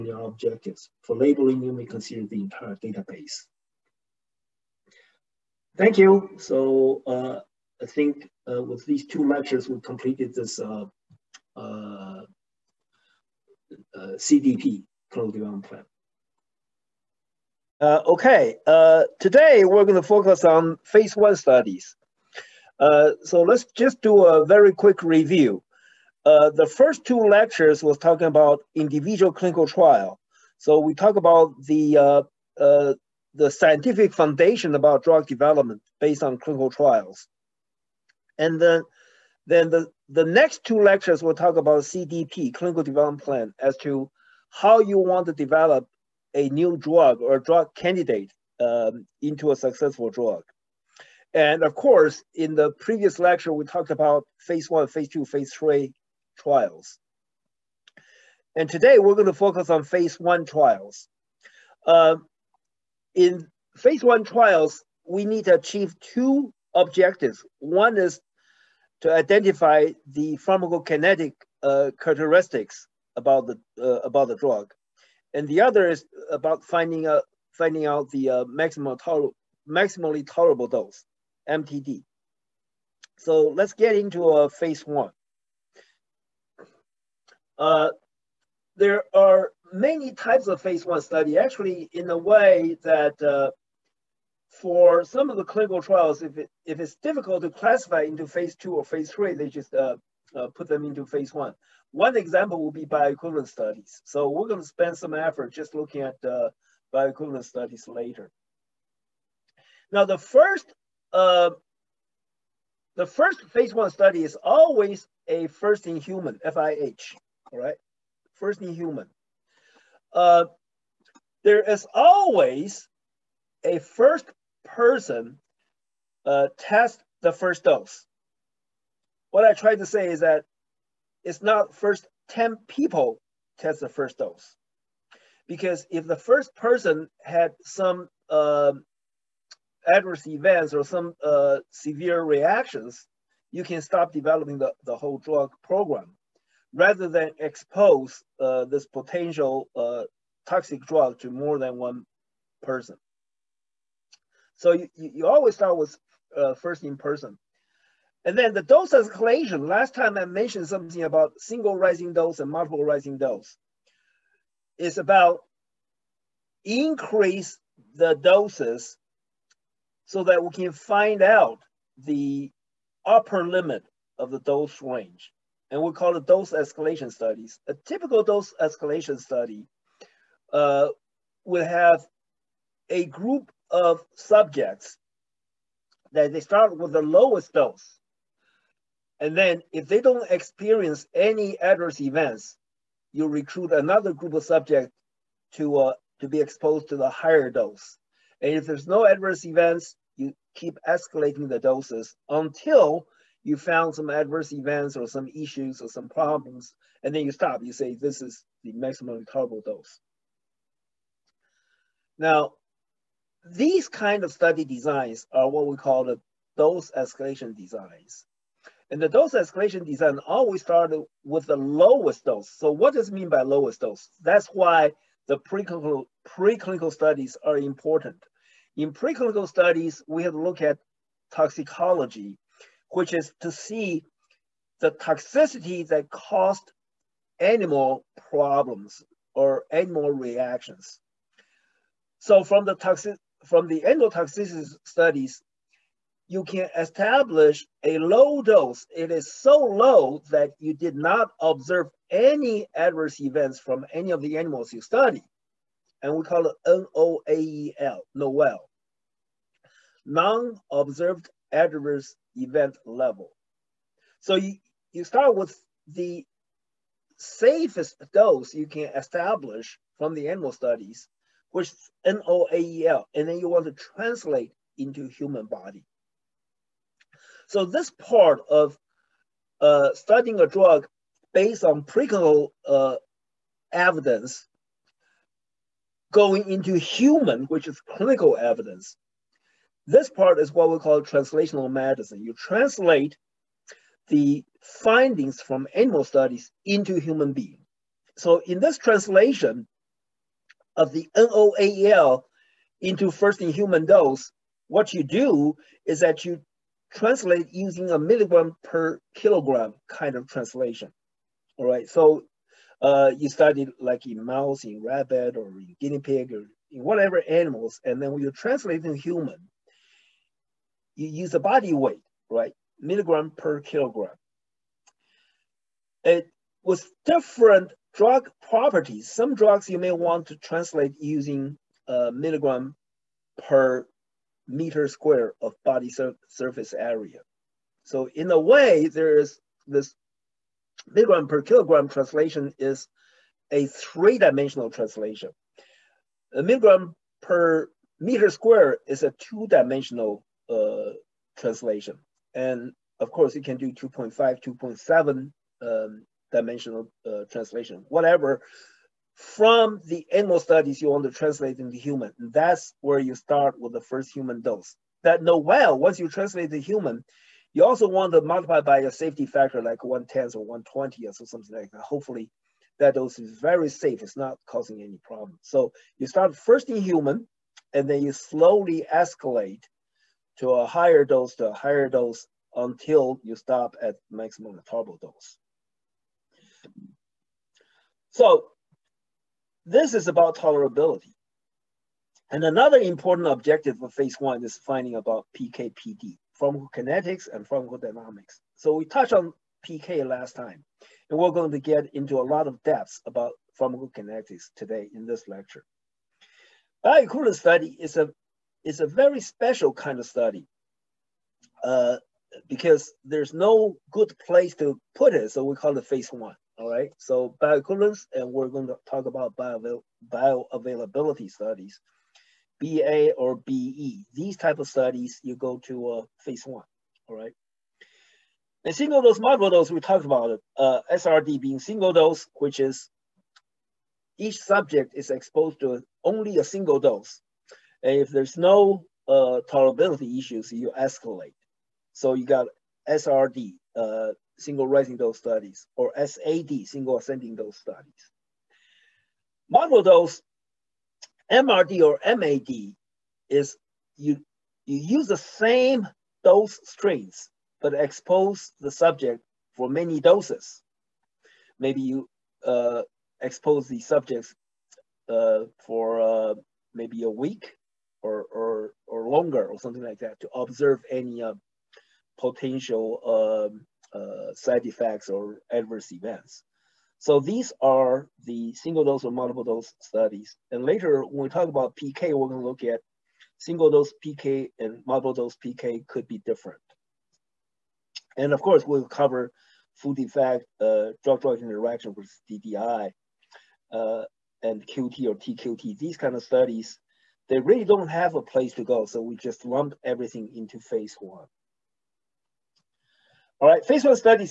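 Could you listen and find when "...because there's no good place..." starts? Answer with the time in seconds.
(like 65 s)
412 s.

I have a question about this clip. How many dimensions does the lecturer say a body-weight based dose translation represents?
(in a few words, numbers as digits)
3.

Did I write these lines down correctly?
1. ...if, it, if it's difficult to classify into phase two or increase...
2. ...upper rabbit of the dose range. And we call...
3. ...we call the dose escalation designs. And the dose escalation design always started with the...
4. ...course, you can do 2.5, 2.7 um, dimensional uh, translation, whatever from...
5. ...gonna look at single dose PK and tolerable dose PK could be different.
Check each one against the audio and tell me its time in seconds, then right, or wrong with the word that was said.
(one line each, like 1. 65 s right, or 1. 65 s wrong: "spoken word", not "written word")
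1. 96 s wrong: "phase", not "increase"
2. 173 s wrong: "limit", not "rabbit"
3. 215 s right
4. 353 s right
5. 482 s wrong: "multiple", not "tolerable".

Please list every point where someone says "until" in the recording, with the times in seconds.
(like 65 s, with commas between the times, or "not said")
202 s, 382 s.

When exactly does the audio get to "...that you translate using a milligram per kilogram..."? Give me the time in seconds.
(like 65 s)
306 s.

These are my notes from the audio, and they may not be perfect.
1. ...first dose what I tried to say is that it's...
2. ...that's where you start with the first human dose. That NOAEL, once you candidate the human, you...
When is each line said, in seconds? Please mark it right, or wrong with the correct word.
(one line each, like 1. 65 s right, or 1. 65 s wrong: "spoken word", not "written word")
1. 127 s right
2. 362 s wrong: "translate", not "candidate".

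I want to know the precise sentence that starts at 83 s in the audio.
So let's get into uh, phase one.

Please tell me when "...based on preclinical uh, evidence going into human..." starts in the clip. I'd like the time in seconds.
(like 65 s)
281 s.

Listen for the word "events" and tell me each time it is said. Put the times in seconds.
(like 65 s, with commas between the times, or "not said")
140 s, 191 s, 199 s, 204 s, 253 s, 262 s, 475 s.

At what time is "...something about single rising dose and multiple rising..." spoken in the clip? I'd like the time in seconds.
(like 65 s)
160 s.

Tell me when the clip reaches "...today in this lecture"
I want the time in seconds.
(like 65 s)
404 s.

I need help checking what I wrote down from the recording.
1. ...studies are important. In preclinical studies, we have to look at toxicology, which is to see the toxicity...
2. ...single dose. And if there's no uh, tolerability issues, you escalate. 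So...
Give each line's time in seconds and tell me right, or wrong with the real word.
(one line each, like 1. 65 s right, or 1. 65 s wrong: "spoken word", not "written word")
1. 226 s right
2. 436 s right.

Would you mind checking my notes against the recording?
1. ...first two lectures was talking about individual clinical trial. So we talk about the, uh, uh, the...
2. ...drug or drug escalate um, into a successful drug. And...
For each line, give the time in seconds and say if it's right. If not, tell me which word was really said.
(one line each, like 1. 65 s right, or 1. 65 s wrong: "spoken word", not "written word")
1. 26 s right
2. 46 s wrong: "candidate", not "escalate".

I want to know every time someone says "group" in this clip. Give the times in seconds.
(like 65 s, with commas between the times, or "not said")
183 s, 194 s.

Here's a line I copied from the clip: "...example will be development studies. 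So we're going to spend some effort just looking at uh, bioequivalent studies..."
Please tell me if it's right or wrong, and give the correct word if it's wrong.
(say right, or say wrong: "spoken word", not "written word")
wrong: "bioequivalent", not "development".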